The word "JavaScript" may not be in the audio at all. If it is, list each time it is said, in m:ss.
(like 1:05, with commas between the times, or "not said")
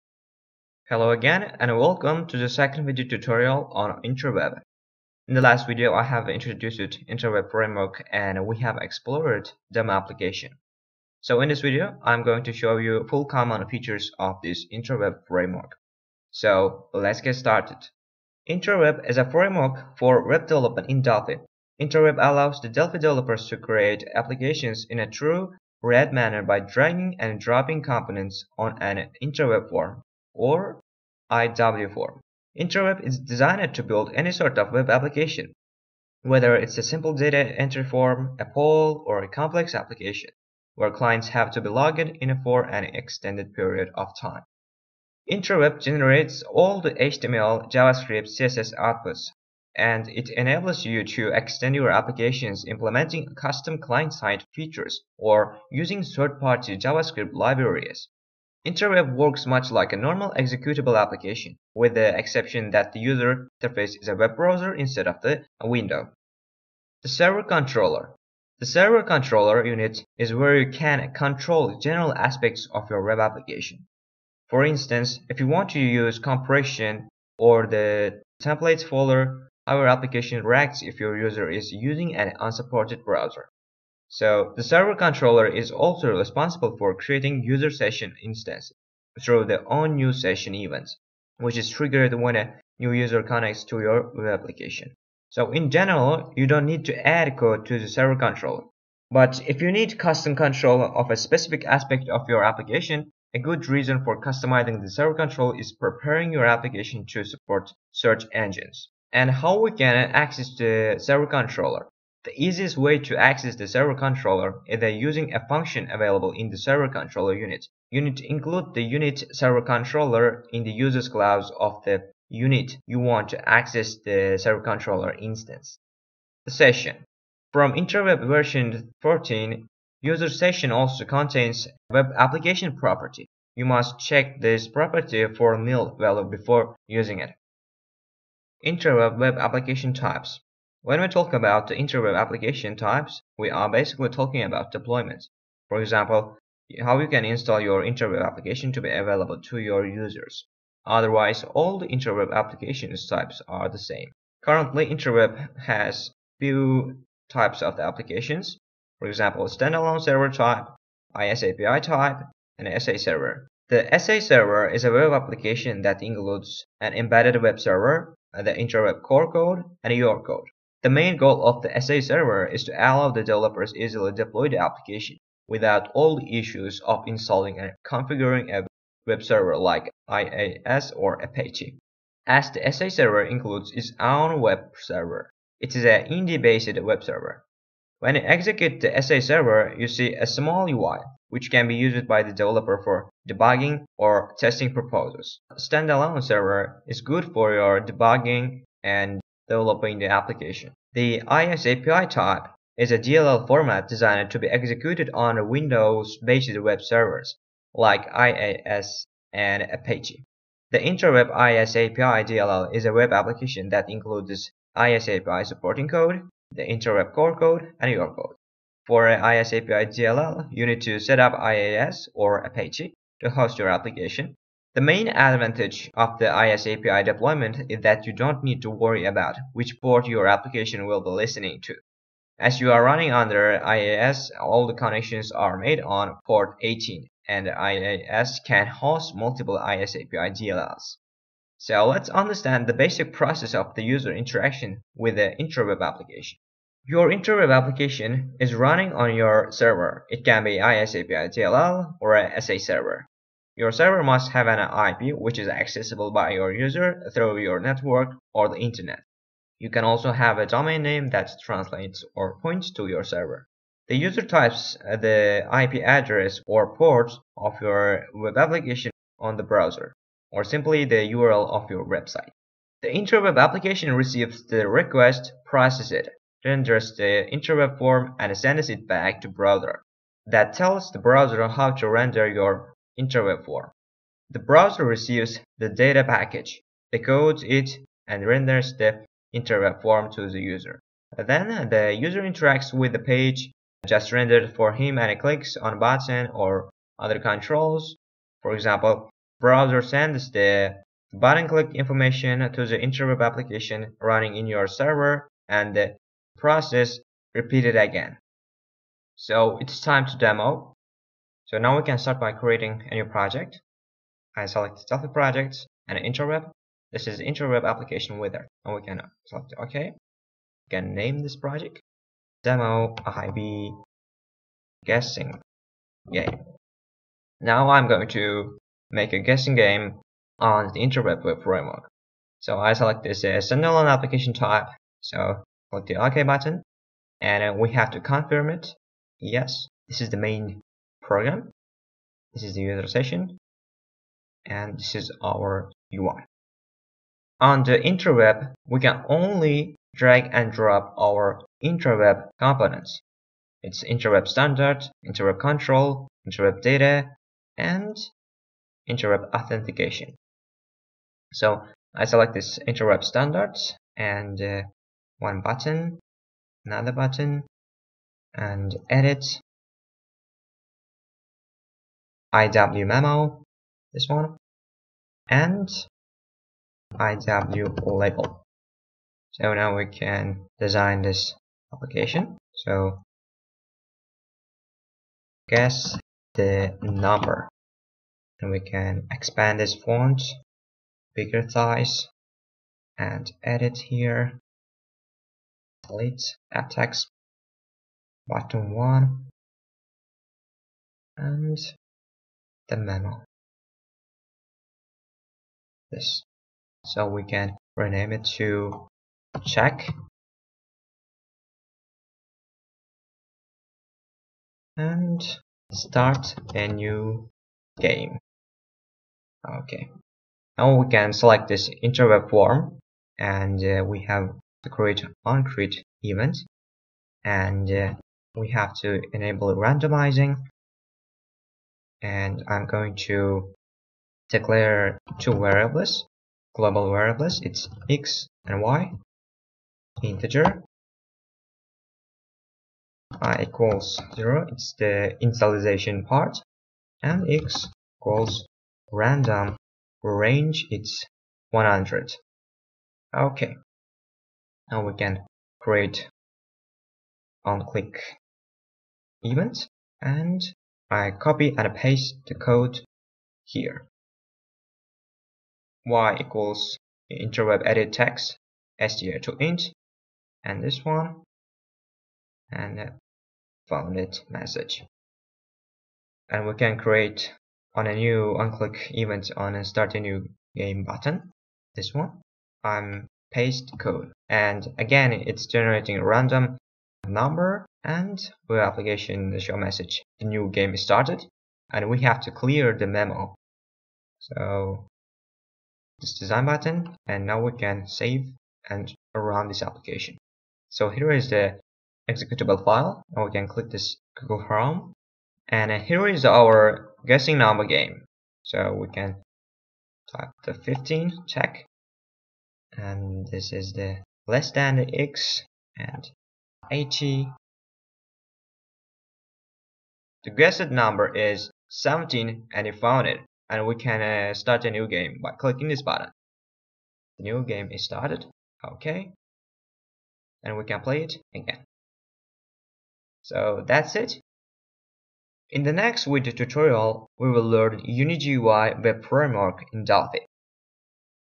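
0:47, 0:56.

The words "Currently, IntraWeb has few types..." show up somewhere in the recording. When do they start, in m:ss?
2:34.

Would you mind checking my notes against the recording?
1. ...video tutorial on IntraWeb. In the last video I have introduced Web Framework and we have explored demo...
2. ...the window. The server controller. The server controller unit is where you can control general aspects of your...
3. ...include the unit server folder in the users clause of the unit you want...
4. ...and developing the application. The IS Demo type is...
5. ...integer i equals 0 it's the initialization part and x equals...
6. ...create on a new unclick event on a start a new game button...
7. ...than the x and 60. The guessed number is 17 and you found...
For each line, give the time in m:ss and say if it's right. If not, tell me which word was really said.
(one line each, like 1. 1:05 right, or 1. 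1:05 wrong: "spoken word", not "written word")
1. 0:02 wrong: "IntraWeb", not "Web"
2. 1:05 right
3. 1:58 wrong: "controller", not "folder"
4. 3:18 wrong: "API", not "Demo"
5. 7:20 right
6. 7:56 right
7. 8:34 wrong: "80", not "60".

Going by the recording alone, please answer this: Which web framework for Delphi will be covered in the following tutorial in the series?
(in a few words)
UniGUI.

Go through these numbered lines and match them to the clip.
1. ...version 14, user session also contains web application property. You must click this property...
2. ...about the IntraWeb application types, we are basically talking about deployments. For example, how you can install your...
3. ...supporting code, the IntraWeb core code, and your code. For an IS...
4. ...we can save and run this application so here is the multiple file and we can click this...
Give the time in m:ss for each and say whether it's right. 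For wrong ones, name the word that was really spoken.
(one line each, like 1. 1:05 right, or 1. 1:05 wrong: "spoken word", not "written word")
1. 2:08 wrong: "check", not "click"
2. 2:21 right
3. 3:35 right
4. 8:17 wrong: "executable", not "multiple".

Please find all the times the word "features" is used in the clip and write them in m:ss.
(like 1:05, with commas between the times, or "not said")
0:13, 0:54.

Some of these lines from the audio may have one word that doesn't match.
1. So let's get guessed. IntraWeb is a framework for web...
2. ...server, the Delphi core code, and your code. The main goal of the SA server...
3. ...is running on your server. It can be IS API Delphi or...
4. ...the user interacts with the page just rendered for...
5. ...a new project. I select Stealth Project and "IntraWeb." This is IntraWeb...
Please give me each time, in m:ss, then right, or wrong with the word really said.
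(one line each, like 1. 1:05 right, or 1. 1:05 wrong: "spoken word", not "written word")
1. 0:16 wrong: "started", not "guessed"
2. 2:47 wrong: "IntraWeb", not "Delphi"
3. 4:08 wrong: "DLL", not "Delphi"
4. 4:51 right
5. 5:12 right.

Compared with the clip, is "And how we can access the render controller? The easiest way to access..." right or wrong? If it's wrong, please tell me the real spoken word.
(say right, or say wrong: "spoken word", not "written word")
wrong: "server", not "render".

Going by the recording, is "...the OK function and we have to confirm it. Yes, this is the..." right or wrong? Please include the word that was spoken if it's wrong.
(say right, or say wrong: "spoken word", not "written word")
wrong: "button", not "function".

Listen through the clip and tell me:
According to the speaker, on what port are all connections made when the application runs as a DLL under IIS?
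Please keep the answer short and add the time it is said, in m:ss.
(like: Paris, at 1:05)
18, at 3:56.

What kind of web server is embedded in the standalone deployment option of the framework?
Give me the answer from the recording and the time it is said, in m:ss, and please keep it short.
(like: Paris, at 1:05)
Indy-based, at 3:06.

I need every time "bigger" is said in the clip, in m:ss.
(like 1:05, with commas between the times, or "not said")
6:31.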